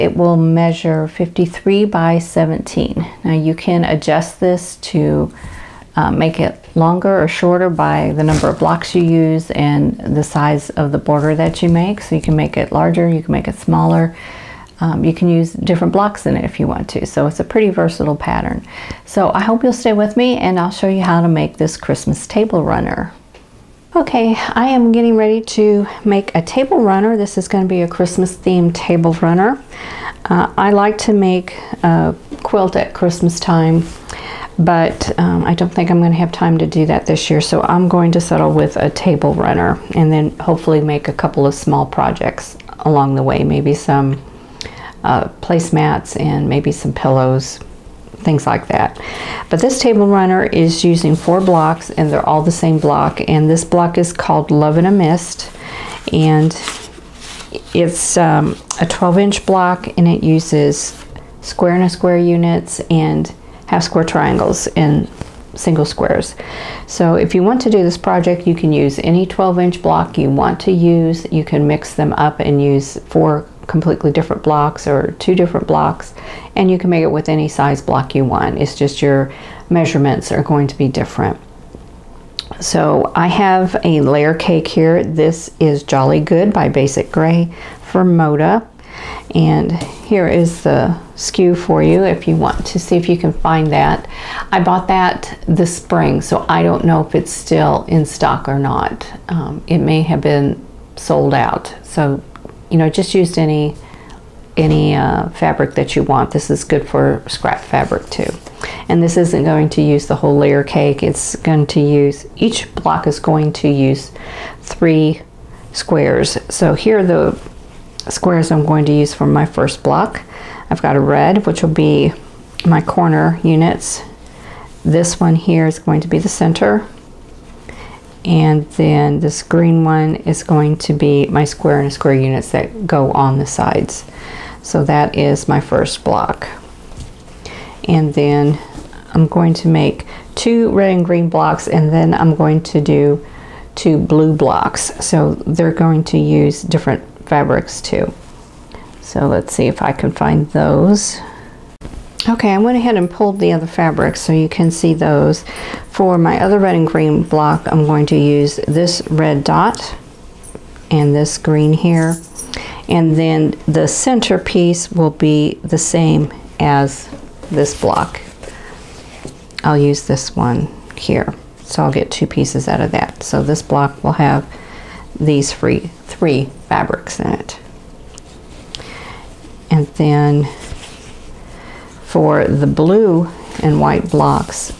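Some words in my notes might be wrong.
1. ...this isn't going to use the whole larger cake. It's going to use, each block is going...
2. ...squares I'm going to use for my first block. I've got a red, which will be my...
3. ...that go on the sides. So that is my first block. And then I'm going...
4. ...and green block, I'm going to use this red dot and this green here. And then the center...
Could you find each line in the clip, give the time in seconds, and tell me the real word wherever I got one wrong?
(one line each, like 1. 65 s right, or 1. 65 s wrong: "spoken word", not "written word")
1. 109 s wrong: "layer", not "larger"
2. 118 s right
3. 132 s right
4. 156 s right.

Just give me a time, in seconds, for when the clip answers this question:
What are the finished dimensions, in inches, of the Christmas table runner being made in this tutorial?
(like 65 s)
1 s.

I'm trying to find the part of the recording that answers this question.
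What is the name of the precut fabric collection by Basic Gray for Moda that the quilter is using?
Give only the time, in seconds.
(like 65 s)
85 s.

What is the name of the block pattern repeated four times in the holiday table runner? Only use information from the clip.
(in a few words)
Love in a Mist.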